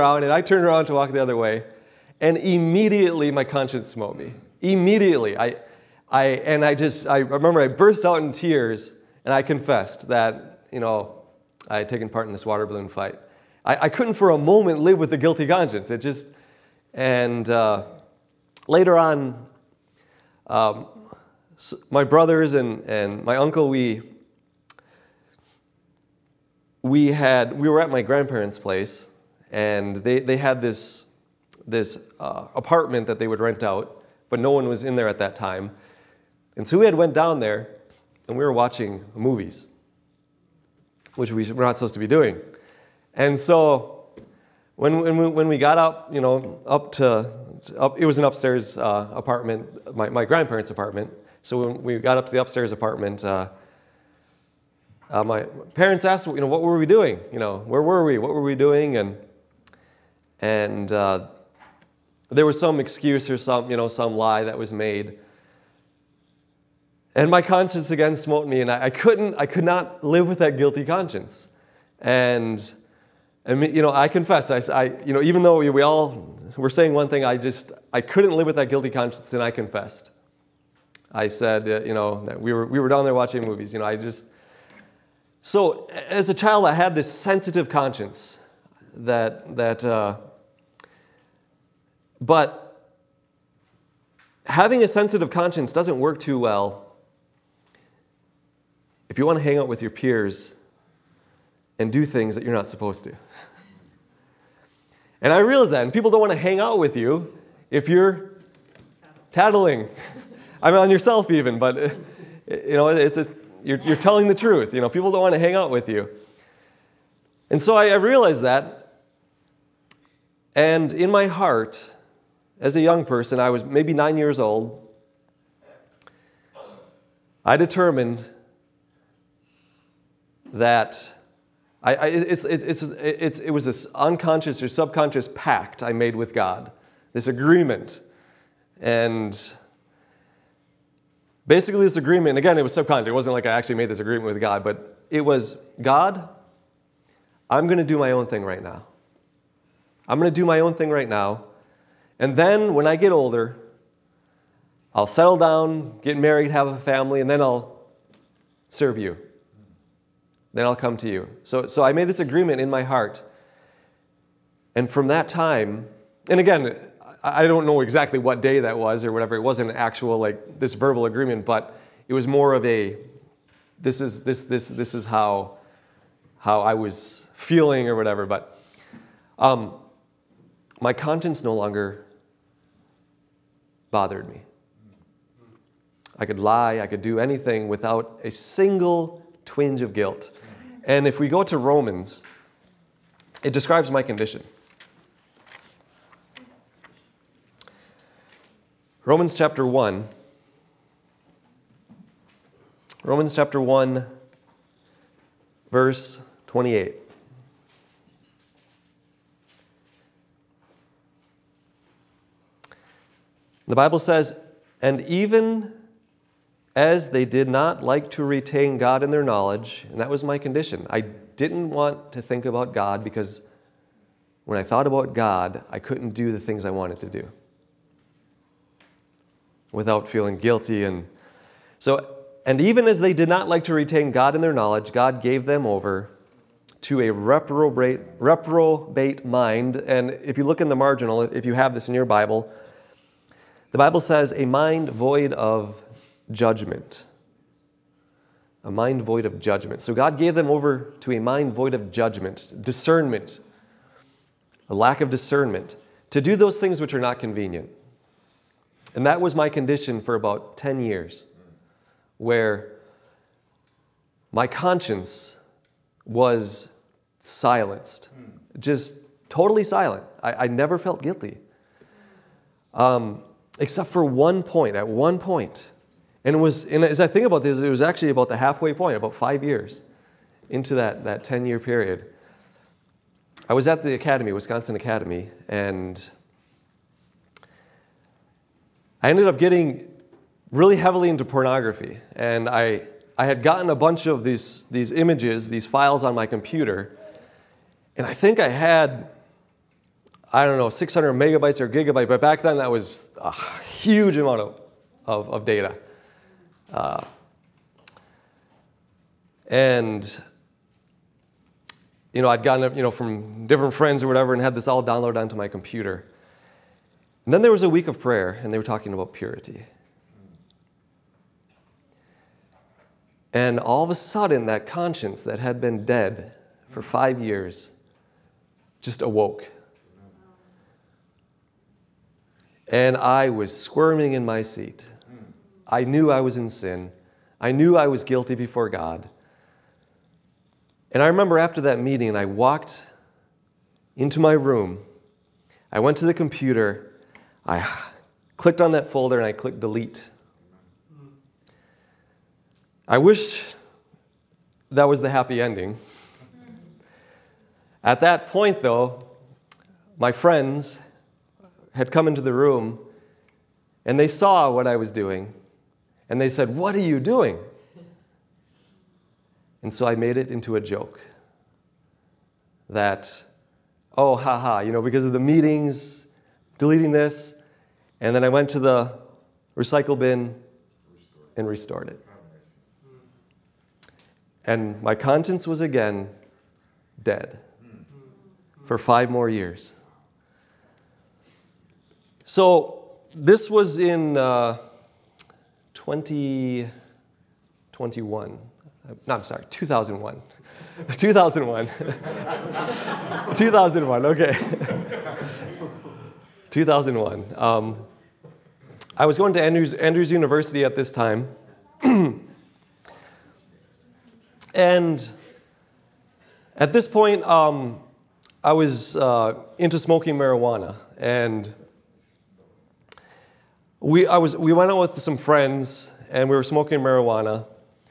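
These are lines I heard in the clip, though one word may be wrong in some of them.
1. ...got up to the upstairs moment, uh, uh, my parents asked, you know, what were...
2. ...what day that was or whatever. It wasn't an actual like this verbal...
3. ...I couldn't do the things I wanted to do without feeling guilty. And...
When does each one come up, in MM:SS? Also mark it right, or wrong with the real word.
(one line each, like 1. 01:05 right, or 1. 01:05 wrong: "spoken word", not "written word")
1. 00:51 wrong: "apartment", not "moment"
2. 02:48 right
3. 03:45 right.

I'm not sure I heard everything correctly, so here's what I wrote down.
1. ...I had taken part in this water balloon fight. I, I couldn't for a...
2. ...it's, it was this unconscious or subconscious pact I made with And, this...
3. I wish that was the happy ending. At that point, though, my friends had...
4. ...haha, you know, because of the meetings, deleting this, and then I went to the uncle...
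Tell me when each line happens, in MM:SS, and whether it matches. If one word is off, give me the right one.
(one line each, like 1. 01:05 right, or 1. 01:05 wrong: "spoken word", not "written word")
1. 00:11 right
2. 02:12 wrong: "God", not "And"
3. 05:52 right
4. 06:14 wrong: "recycle", not "uncle".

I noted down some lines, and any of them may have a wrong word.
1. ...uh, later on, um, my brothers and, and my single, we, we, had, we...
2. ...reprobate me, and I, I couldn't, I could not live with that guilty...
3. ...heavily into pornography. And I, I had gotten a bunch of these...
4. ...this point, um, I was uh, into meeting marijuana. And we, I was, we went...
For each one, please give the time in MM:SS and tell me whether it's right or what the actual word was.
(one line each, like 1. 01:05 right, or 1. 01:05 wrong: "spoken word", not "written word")
1. 00:17 wrong: "uncle", not "single"
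2. 01:08 wrong: "smote", not "reprobate"
3. 04:50 right
4. 06:56 wrong: "smoking", not "meeting".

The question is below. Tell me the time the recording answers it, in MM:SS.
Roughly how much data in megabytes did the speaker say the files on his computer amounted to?
05:00.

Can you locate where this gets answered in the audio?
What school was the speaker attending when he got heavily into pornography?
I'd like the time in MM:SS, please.
04:44.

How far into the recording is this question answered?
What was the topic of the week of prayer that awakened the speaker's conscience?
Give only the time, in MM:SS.
05:19.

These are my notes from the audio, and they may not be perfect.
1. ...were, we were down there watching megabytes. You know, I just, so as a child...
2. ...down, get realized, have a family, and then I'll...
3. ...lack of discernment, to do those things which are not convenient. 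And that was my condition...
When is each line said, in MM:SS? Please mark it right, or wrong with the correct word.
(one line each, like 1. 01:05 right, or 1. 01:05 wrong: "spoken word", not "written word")
1. 01:22 wrong: "movies", not "megabytes"
2. 02:35 wrong: "married", not "realized"
3. 04:14 right.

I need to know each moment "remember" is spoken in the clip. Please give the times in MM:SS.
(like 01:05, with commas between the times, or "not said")
00:07, 05:41.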